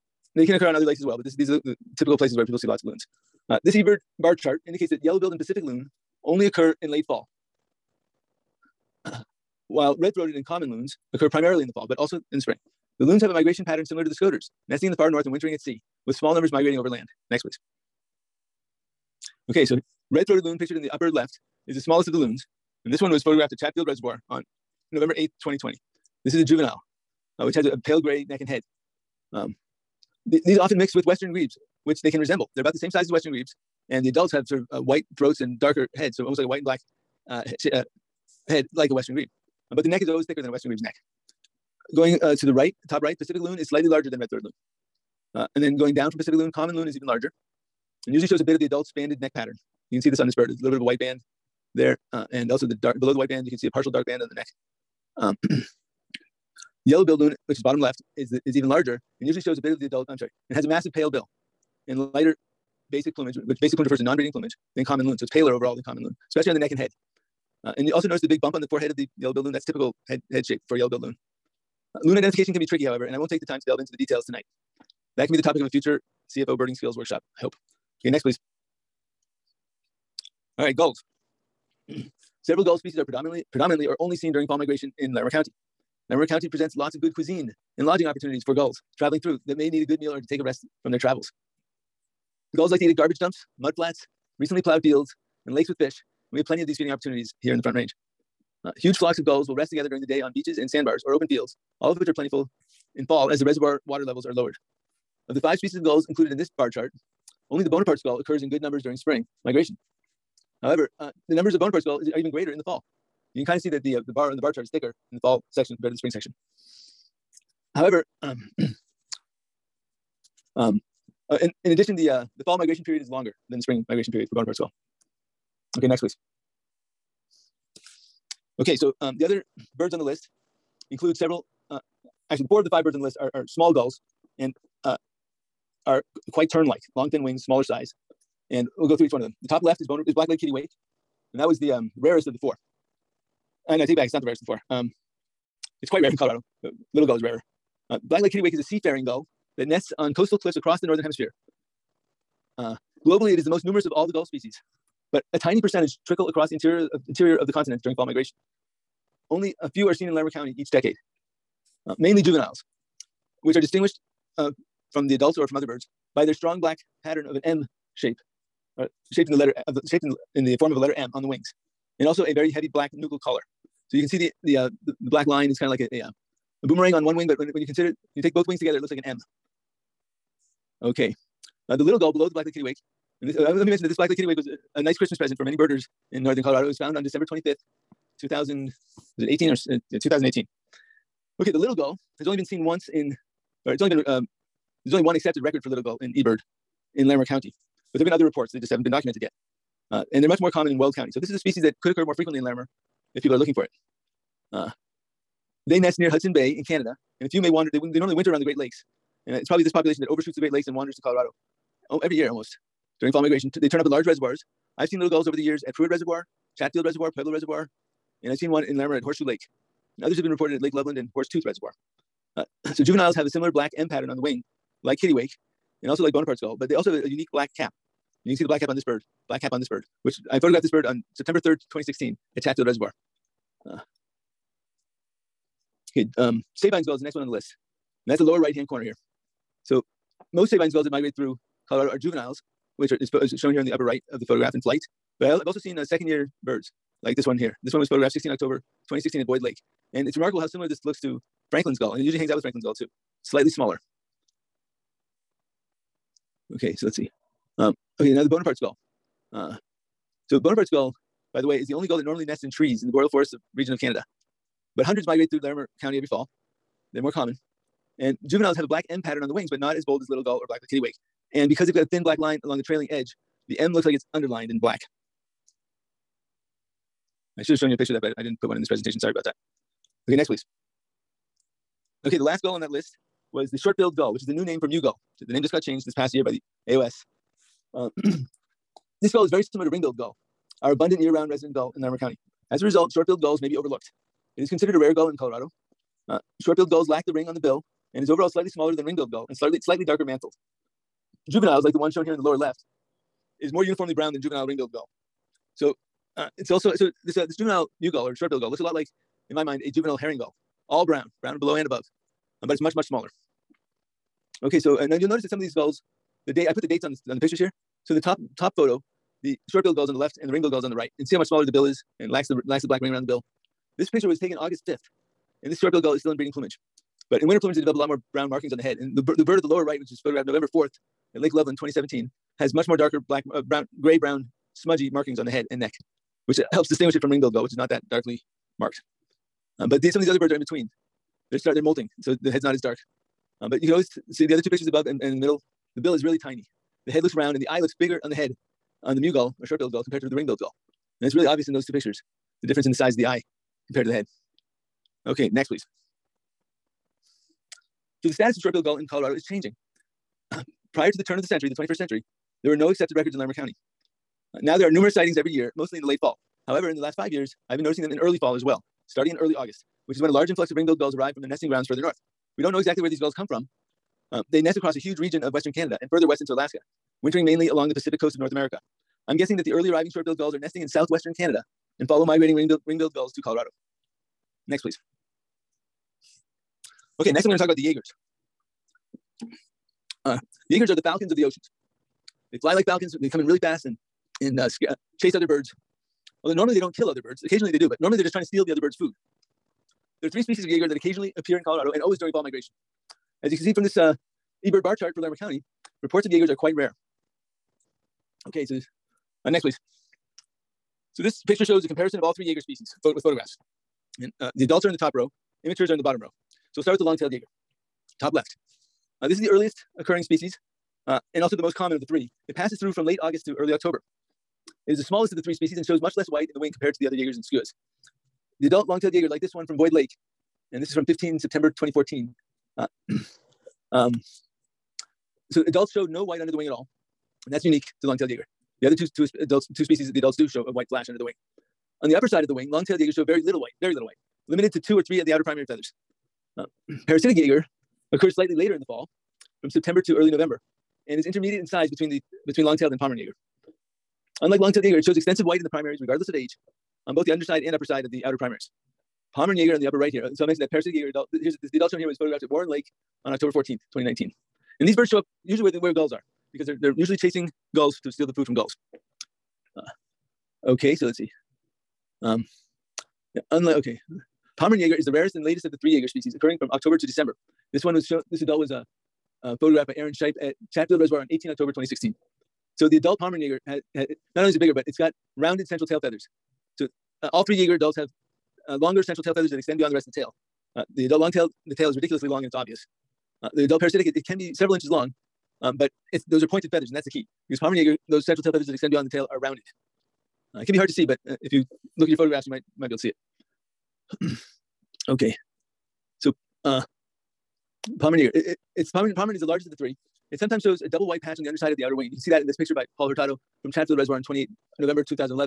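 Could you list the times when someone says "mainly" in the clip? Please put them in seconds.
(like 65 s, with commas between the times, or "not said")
161 s, 377 s.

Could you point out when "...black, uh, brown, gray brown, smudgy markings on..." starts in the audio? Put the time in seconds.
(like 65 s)
333 s.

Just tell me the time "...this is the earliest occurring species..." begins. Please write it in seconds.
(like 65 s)
419 s.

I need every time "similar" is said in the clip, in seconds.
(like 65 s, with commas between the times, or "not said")
13 s, 223 s, 250 s, 289 s.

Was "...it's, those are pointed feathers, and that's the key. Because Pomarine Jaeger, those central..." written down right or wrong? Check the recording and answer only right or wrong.
right.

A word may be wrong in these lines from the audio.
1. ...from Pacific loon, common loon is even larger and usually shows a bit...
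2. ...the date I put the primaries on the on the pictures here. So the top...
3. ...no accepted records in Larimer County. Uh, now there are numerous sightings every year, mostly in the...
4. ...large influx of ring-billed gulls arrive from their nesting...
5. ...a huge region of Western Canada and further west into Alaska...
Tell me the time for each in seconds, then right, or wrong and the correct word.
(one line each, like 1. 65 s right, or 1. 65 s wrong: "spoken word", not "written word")
1. 46 s right
2. 316 s wrong: "dates", not "primaries"
3. 362 s right
4. 370 s right
5. 374 s right.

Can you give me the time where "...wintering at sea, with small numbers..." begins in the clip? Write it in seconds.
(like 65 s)
15 s.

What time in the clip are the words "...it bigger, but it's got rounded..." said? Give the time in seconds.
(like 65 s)
484 s.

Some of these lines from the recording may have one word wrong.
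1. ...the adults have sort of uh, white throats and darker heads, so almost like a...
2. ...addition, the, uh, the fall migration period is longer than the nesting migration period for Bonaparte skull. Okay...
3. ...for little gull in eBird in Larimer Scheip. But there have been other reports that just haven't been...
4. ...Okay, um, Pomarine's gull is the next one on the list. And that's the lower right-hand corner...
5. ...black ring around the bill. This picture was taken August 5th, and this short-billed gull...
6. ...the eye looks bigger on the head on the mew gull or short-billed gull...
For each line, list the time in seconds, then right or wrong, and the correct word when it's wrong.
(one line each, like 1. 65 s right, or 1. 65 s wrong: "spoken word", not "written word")
1. 34 s right
2. 121 s wrong: "spring", not "nesting"
3. 195 s wrong: "County", not "Scheip"
4. 235 s wrong: "Sabine", not "Pomarine"
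5. 322 s right
6. 347 s right.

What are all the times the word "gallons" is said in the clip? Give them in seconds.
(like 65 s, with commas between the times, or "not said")
not said.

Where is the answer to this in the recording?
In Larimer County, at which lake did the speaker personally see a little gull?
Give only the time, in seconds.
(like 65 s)
219 s.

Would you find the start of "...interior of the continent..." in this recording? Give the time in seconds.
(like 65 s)
157 s.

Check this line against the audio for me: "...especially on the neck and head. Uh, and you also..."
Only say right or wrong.
right.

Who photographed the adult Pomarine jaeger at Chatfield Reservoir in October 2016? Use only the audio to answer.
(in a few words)
Aaron Scheip.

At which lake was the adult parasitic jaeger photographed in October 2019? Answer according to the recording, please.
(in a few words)
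Warren Lake.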